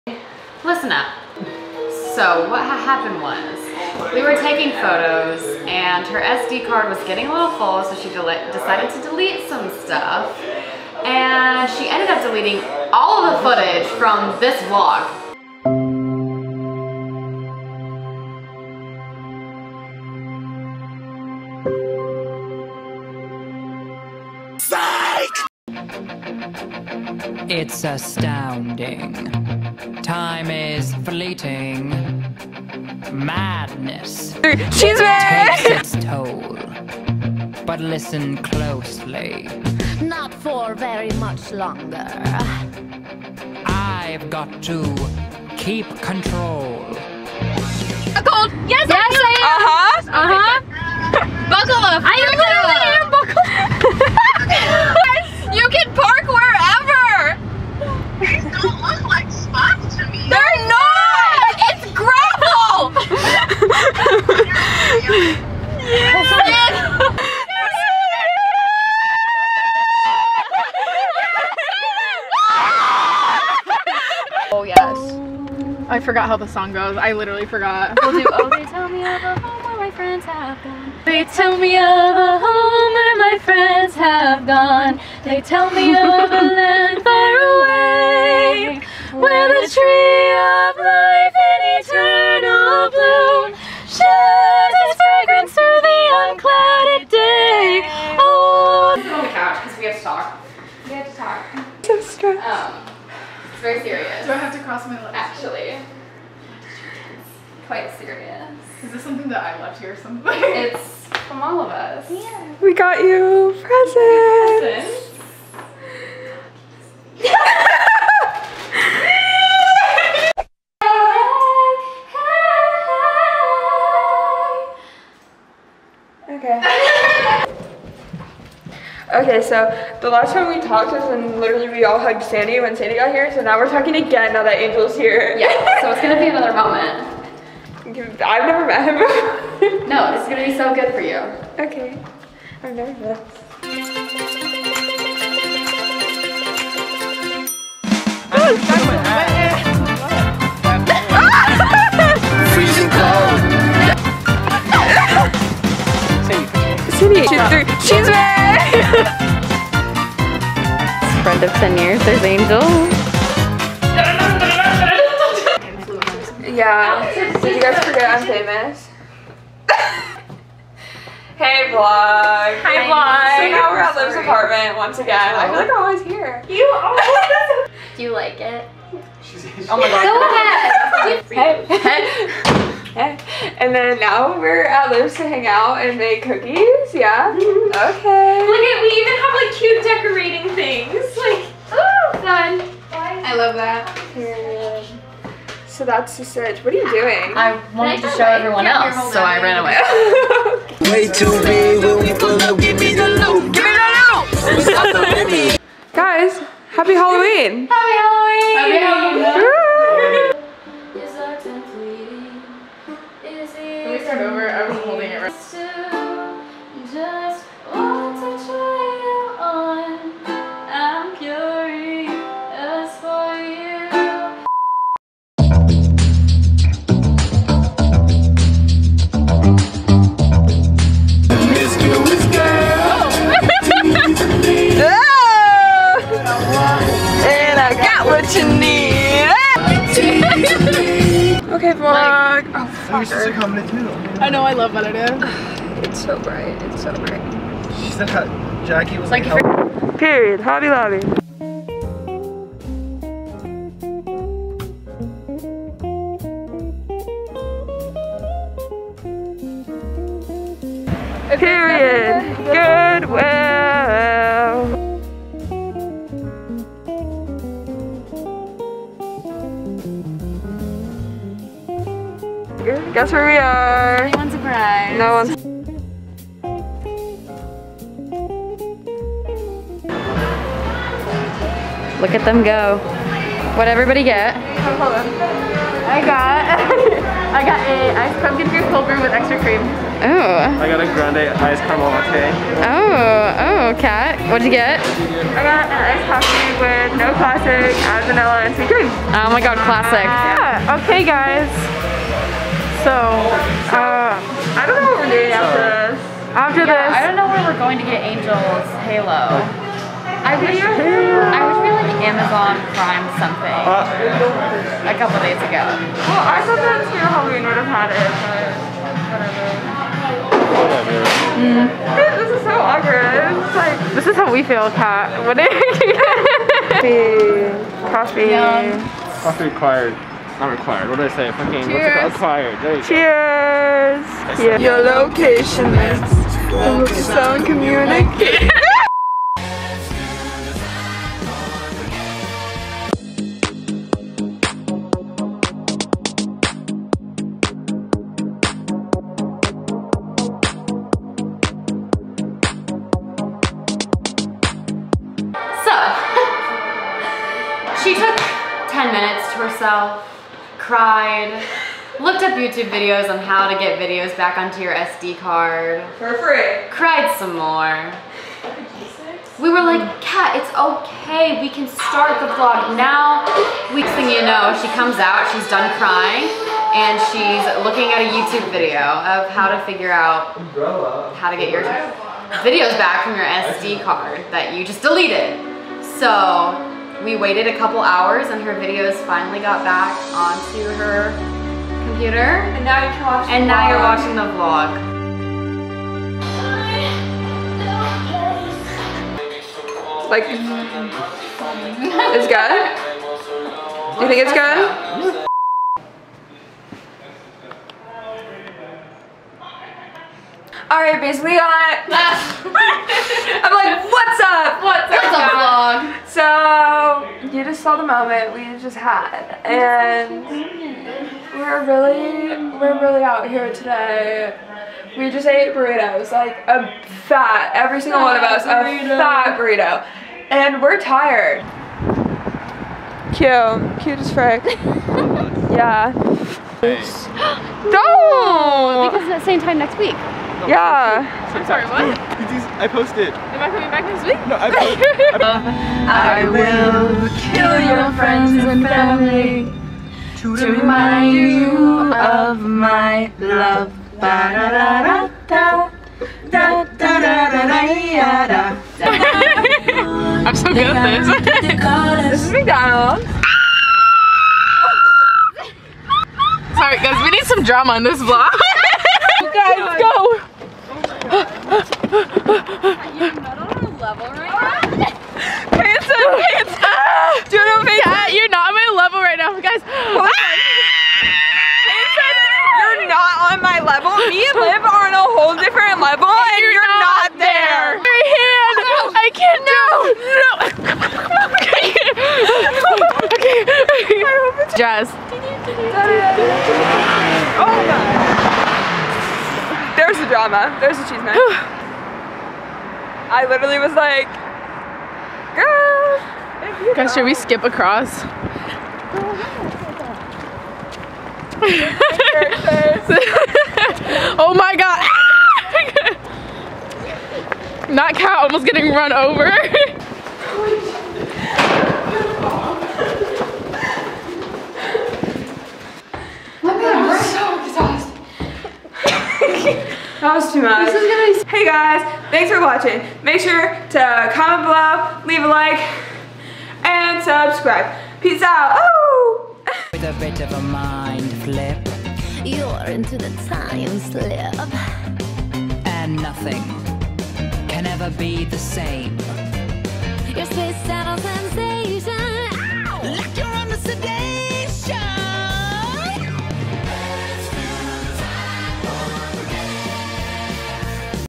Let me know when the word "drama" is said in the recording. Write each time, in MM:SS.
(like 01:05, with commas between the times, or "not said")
07:47, 08:20.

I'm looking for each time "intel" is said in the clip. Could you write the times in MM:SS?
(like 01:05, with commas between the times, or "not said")
not said.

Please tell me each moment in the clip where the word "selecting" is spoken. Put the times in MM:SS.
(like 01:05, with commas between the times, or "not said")
not said.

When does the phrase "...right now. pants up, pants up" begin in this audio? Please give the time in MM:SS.
07:54.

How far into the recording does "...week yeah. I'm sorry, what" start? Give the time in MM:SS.
07:19.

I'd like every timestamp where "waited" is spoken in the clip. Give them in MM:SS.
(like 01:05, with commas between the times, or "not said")
06:27.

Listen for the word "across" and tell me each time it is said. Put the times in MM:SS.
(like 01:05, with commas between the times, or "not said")
08:27.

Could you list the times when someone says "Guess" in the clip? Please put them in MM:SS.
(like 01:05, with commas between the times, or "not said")
04:32.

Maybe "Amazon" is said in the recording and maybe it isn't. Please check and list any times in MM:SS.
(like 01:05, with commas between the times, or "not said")
05:12.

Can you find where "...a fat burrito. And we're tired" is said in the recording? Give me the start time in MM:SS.
07:08.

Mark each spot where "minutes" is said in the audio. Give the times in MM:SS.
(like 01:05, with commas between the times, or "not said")
05:58.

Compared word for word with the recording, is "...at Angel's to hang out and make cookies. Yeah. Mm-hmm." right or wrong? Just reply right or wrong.
wrong.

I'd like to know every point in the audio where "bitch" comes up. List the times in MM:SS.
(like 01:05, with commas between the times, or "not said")
06:51.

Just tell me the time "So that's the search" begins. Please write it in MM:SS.
03:15.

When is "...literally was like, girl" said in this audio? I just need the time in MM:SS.
08:23.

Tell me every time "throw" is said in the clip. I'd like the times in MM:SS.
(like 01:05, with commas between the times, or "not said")
not said.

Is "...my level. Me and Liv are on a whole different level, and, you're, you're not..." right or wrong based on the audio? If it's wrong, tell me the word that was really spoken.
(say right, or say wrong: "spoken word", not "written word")
right.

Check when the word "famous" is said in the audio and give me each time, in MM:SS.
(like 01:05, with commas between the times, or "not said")
02:48.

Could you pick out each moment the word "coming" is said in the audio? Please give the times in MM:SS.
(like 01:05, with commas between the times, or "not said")
07:23.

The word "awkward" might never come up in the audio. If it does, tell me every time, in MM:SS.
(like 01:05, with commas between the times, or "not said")
05:22.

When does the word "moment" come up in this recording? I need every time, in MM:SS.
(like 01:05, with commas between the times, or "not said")
02:16, 06:57.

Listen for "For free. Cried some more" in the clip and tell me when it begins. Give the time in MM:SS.
06:05.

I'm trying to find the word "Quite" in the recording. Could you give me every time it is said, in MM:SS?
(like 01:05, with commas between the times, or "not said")
01:47.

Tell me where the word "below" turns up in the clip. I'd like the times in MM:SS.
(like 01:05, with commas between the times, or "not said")
08:54.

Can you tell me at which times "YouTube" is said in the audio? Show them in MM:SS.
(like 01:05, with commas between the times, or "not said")
06:02, 06:18.